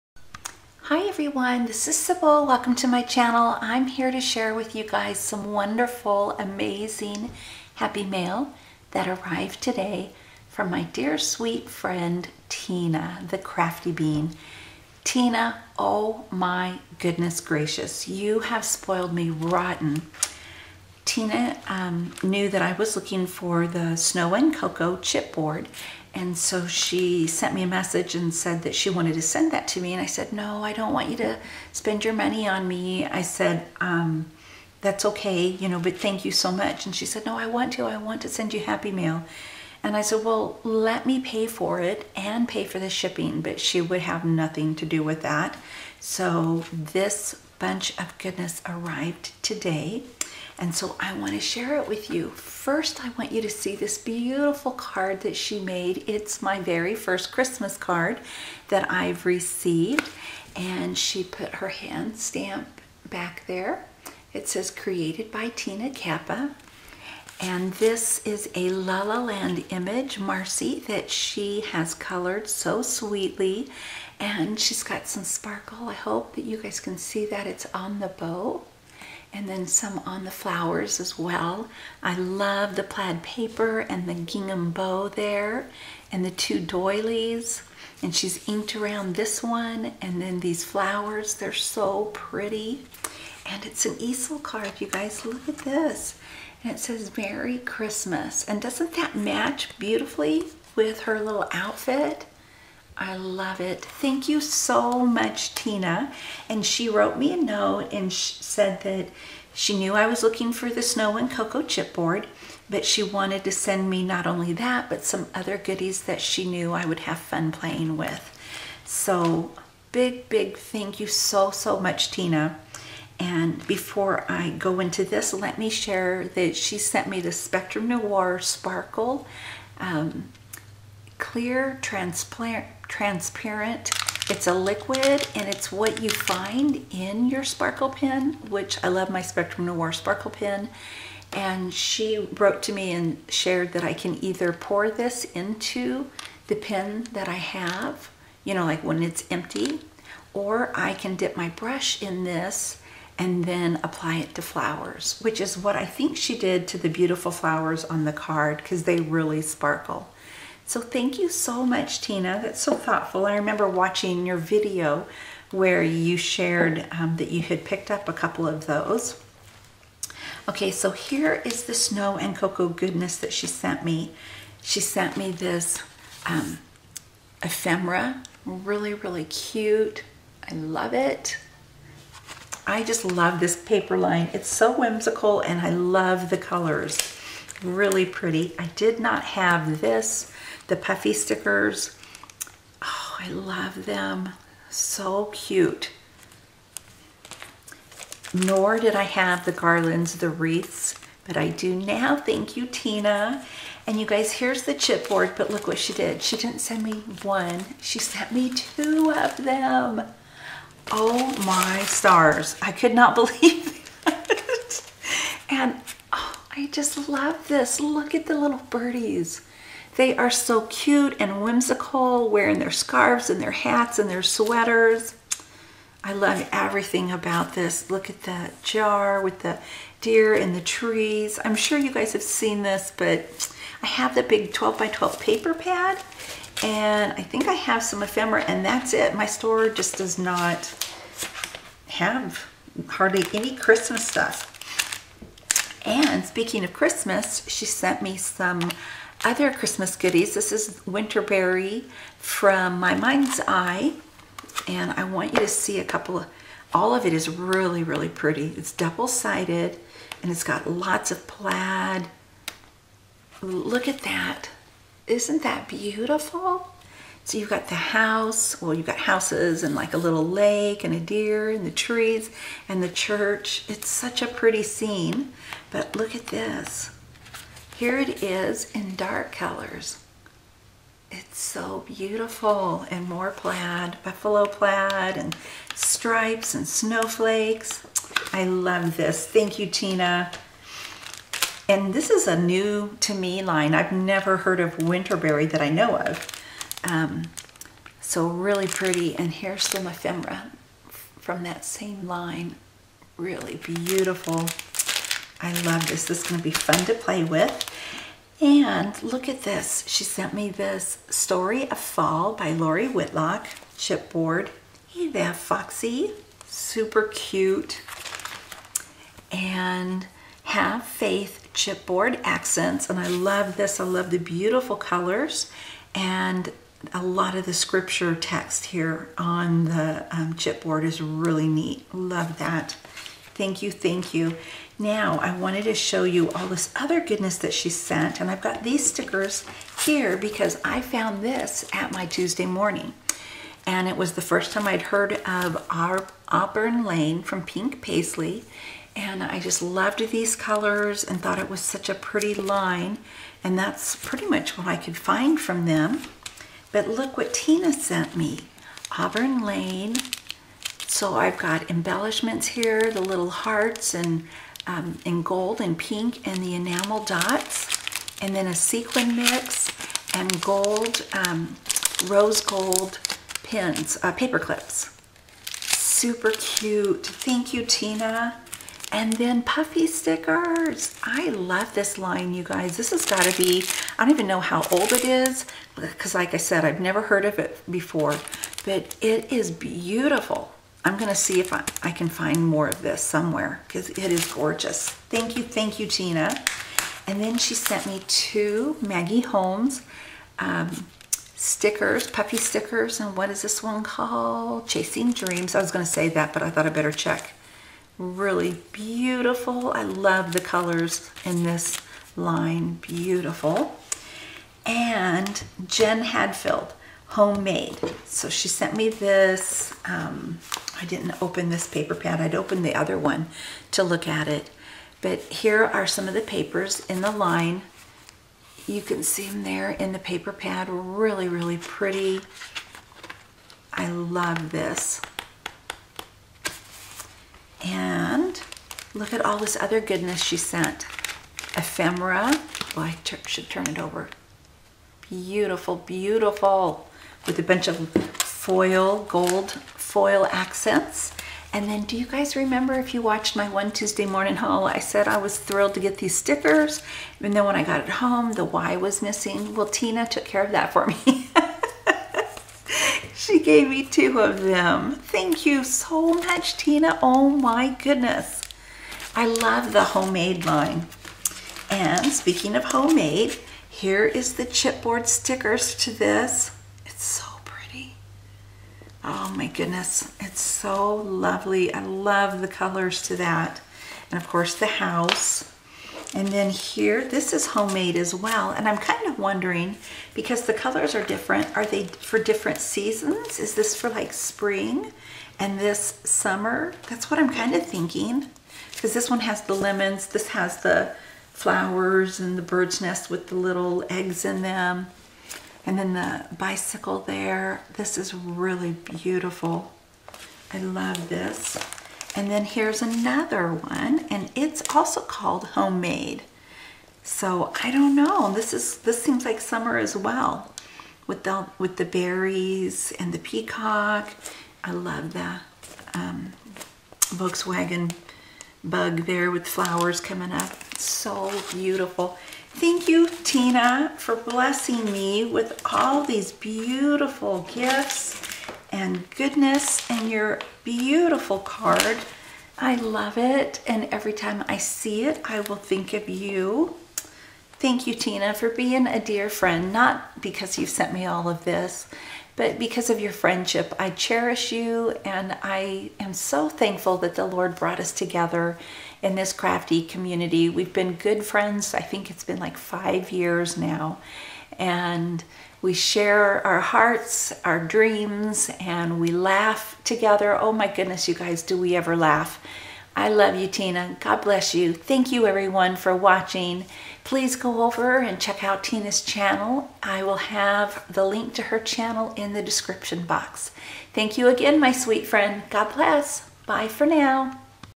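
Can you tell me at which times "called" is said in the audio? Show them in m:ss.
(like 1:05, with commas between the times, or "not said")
6:43, 8:35.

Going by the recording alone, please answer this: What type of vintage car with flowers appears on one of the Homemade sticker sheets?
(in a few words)
Volkswagen bug.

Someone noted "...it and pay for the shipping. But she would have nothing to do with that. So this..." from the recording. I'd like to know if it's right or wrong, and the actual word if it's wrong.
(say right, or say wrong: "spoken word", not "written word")
right.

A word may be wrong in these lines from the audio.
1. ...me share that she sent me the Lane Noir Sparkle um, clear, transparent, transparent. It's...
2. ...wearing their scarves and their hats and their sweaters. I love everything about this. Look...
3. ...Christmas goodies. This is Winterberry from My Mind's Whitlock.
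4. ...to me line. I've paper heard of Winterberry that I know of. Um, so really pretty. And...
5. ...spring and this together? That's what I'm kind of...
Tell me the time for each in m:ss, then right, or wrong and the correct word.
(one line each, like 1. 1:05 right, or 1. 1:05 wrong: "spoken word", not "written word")
1. 2:05 wrong: "Spectrum", not "Lane"
2. 3:42 right
3. 4:09 wrong: "Eye", not "Whitlock"
4. 4:52 wrong: "never", not "paper"
5. 8:14 wrong: "summer", not "together".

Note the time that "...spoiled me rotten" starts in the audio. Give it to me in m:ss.
0:18.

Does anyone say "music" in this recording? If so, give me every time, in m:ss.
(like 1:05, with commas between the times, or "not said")
not said.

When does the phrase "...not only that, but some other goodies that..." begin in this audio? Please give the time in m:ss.
1:54.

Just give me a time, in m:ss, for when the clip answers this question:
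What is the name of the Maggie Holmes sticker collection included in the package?
6:44.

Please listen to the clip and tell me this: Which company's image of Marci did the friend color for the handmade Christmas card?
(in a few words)
La La Land.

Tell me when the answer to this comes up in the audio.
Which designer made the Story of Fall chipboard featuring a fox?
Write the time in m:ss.
5:12.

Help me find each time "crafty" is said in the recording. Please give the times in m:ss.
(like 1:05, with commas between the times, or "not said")
0:13, 9:19.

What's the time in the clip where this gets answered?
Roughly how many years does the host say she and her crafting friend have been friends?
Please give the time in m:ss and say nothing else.
9:22.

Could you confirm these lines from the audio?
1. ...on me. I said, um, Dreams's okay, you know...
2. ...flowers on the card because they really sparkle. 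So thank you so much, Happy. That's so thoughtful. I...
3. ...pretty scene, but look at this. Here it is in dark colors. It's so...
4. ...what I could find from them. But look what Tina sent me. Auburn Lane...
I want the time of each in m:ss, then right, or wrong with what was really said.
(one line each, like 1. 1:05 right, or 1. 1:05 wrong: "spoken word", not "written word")
1. 0:32 wrong: "That", not "Dreams"
2. 2:37 wrong: "Tina", not "Happy"
3. 4:34 right
4. 5:54 right.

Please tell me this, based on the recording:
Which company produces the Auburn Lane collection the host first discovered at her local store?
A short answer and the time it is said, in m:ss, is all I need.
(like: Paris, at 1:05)
Pink Paislee, at 5:47.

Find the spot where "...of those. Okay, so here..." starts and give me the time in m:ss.
2:48.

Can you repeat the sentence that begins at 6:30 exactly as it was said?
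I'm going to see if I, I can find more of this somewhere because it is gorgeous.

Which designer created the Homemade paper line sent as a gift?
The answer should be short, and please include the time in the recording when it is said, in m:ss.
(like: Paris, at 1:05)
Jen Hadfield, at 6:55.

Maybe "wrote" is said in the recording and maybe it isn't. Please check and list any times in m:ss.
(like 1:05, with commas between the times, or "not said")
1:46, 2:22.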